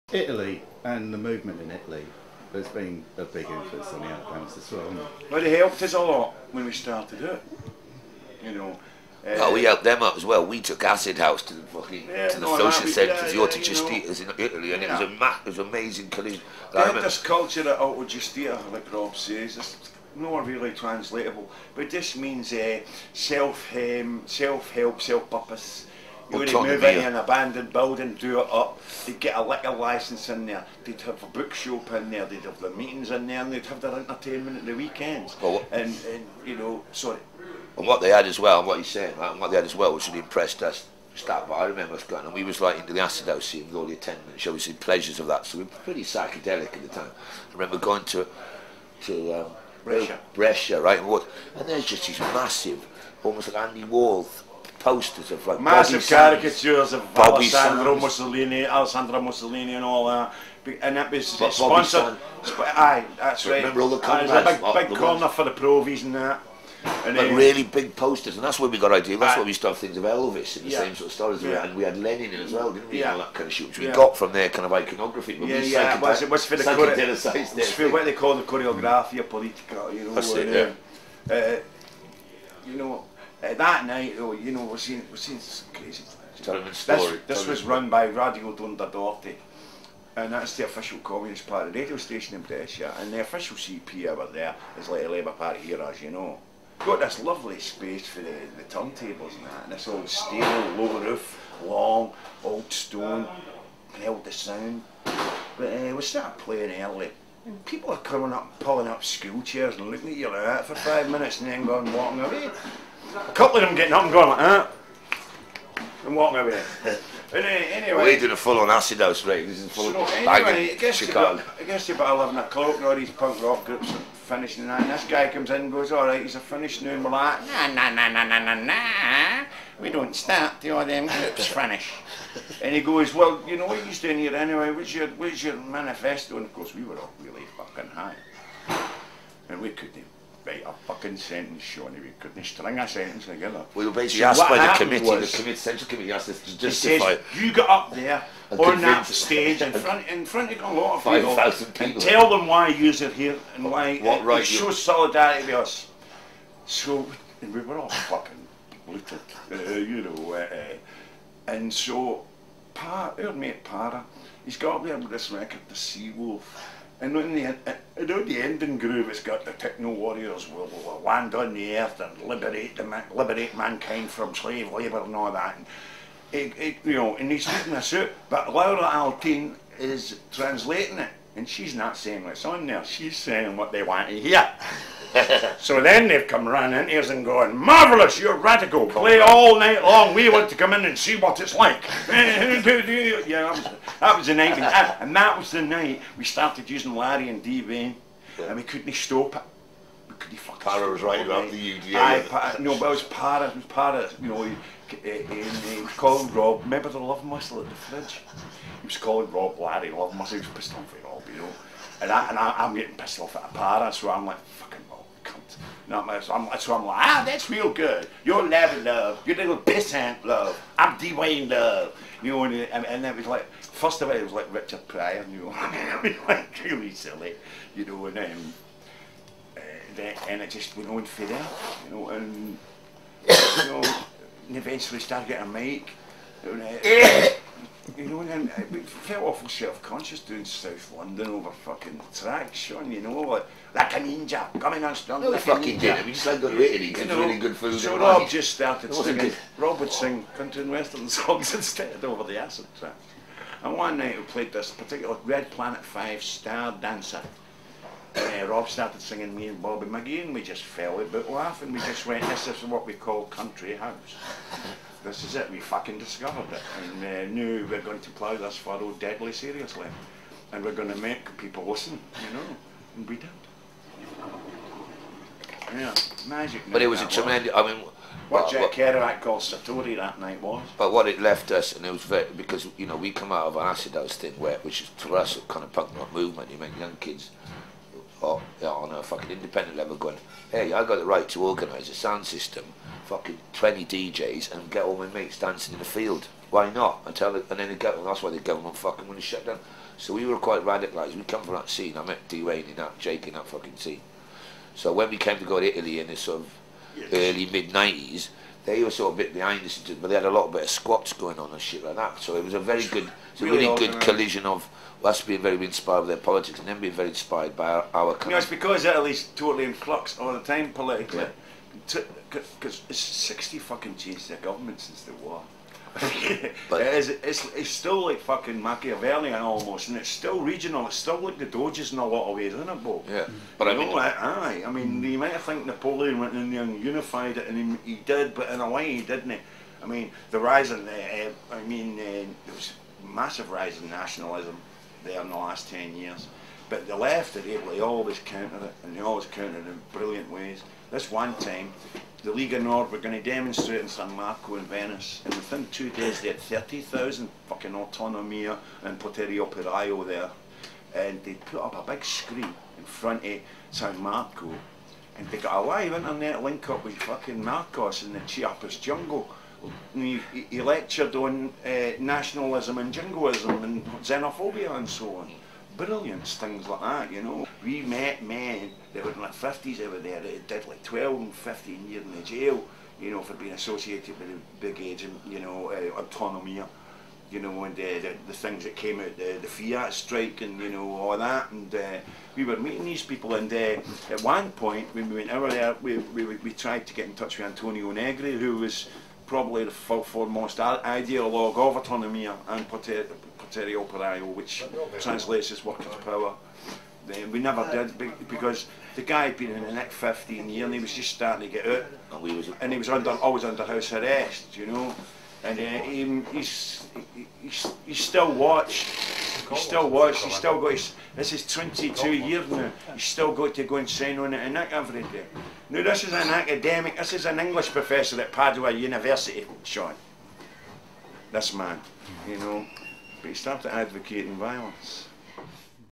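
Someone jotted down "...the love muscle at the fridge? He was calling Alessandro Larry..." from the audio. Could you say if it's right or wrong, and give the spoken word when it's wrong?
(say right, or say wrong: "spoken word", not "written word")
wrong: "Rob", not "Alessandro".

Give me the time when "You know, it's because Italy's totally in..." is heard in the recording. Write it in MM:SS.
05:18.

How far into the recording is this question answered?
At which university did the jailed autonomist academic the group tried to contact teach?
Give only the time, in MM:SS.
07:08.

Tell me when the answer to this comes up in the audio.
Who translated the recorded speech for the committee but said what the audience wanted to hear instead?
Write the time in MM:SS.
02:58.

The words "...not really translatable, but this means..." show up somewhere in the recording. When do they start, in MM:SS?
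00:20.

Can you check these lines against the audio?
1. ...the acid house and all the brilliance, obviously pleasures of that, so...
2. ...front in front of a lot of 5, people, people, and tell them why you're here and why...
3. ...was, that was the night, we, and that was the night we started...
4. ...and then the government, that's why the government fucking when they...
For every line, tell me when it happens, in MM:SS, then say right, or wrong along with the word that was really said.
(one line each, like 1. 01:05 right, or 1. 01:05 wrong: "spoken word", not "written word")
1. 00:42 wrong: "attendance", not "brilliance"
2. 02:29 right
3. 03:13 right
4. 04:57 right.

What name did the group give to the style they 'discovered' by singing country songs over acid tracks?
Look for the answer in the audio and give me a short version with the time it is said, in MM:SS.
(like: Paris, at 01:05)
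country house, at 04:23.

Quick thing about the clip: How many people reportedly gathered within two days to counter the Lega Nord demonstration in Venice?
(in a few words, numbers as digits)
30,000.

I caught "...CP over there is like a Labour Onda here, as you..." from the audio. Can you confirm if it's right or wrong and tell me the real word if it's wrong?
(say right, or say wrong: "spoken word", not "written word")
wrong: "Party", not "Onda".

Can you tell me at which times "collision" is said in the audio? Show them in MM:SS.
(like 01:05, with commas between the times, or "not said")
00:16, 05:13.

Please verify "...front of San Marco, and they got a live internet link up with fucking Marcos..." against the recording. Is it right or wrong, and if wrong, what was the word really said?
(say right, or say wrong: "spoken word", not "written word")
right.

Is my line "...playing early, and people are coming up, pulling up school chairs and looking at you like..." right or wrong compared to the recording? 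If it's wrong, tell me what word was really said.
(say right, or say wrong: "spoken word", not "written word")
right.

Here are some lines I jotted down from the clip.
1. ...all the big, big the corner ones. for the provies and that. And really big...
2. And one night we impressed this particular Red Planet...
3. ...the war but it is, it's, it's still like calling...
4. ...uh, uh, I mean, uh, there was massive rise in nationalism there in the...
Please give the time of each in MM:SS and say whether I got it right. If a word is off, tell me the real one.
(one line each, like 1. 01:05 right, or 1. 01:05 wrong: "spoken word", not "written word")
1. 01:03 right
2. 04:13 wrong: "played", not "impressed"
3. 05:25 wrong: "fucking", not "calling"
4. 05:40 right.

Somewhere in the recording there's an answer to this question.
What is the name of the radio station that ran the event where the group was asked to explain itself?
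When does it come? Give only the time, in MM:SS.
01:28.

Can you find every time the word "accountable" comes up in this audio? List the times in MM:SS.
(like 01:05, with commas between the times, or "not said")
not said.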